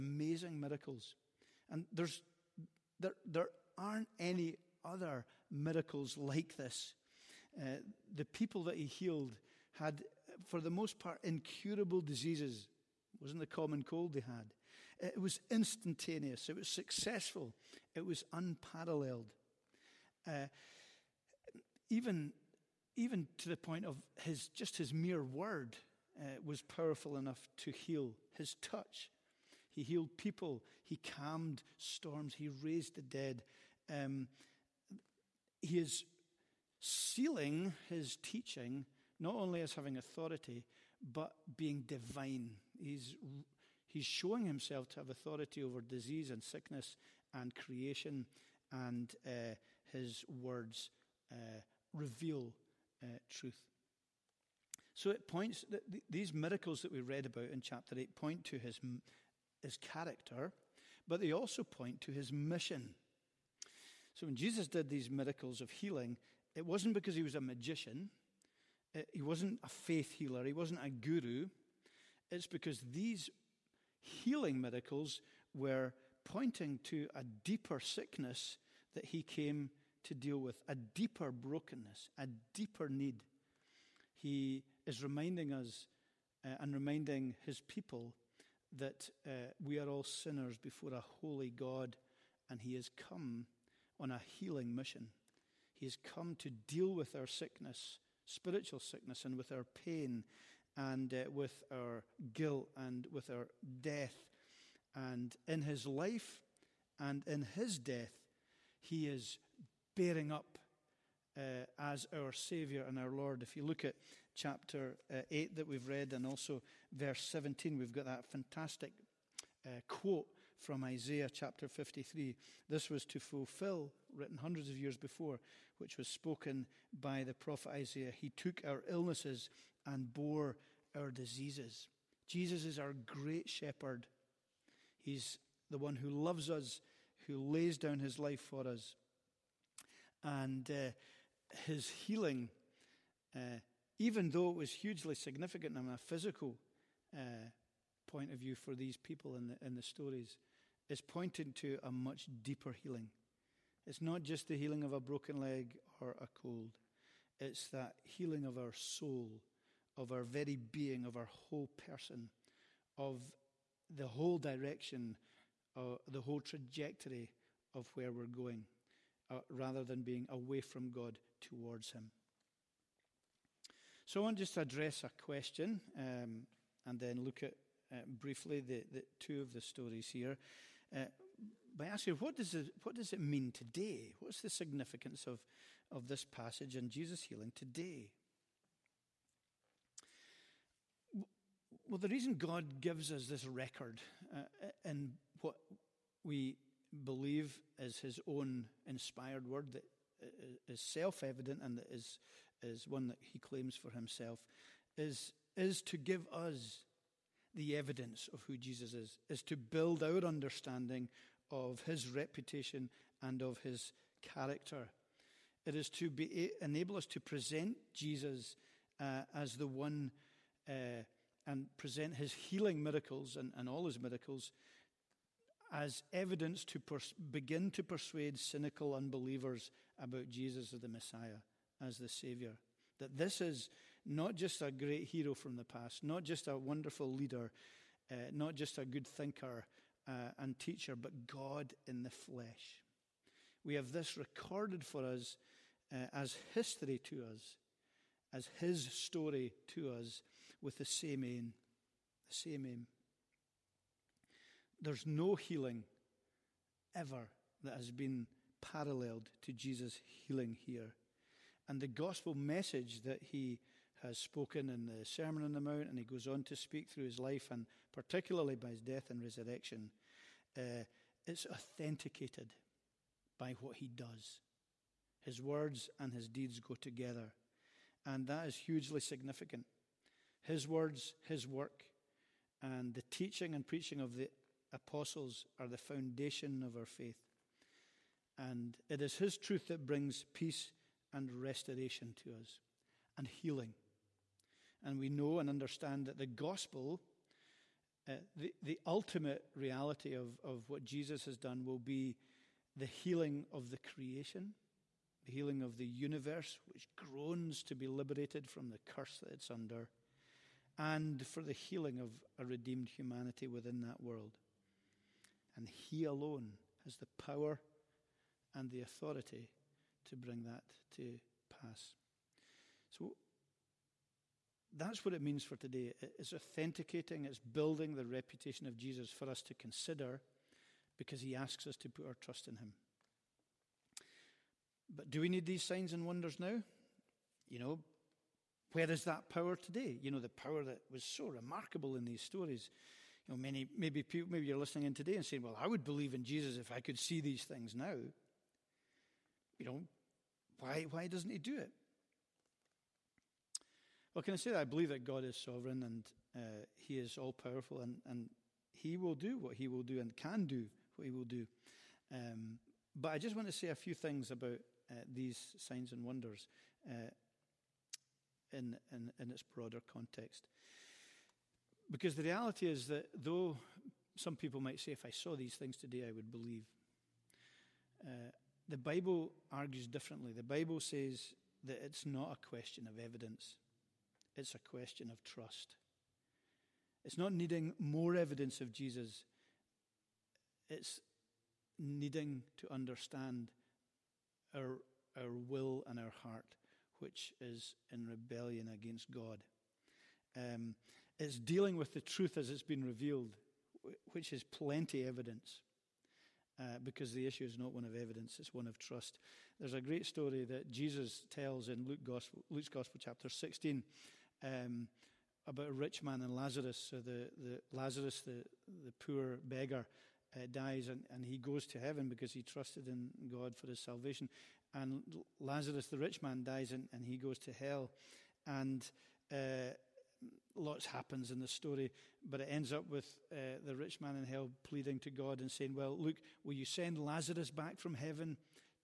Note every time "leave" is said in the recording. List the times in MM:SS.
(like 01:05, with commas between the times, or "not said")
not said.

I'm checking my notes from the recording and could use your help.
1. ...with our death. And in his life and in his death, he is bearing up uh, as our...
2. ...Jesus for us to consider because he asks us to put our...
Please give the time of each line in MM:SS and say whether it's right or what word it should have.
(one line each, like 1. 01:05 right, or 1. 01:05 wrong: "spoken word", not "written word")
1. 01:43 right
2. 05:28 right.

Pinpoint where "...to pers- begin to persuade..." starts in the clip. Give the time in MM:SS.
03:46.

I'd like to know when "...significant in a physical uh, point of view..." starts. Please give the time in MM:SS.
02:25.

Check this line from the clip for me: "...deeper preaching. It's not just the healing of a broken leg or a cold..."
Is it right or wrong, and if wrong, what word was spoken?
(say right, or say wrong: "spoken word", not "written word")
wrong: "healing", not "preaching".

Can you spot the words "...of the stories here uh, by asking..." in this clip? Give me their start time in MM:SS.
02:59.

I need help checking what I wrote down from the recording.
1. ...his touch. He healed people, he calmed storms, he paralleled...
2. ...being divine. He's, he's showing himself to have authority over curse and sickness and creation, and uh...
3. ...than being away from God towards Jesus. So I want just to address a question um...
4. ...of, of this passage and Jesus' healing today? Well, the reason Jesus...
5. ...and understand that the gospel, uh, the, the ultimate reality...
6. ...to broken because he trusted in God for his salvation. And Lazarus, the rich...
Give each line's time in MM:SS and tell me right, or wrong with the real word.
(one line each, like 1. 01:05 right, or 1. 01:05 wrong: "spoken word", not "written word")
1. 00:28 wrong: "raised", not "paralleled"
2. 00:41 wrong: "disease", not "curse"
3. 02:49 wrong: "Him", not "Jesus"
4. 03:05 wrong: "God", not "Jesus"
5. 04:55 right
6. 07:01 wrong: "heaven", not "broken".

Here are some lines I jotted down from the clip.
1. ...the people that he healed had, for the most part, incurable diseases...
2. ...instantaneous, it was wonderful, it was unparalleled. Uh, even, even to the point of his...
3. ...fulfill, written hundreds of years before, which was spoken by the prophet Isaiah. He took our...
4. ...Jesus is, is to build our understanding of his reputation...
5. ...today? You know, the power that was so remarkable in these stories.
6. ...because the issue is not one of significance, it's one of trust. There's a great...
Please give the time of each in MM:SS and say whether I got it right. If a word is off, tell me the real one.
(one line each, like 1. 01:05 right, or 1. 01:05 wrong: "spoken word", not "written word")
1. 00:08 right
2. 00:15 wrong: "successful", not "wonderful"
3. 02:03 right
4. 03:28 right
5. 05:39 right
6. 06:46 wrong: "evidence", not "significance".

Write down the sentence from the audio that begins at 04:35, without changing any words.
His words and his deeds go together, and that is hugely significant.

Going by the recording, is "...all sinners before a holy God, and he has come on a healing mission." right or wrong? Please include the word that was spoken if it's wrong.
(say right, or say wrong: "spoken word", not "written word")
right.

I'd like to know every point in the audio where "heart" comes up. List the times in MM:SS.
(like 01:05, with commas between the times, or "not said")
06:36.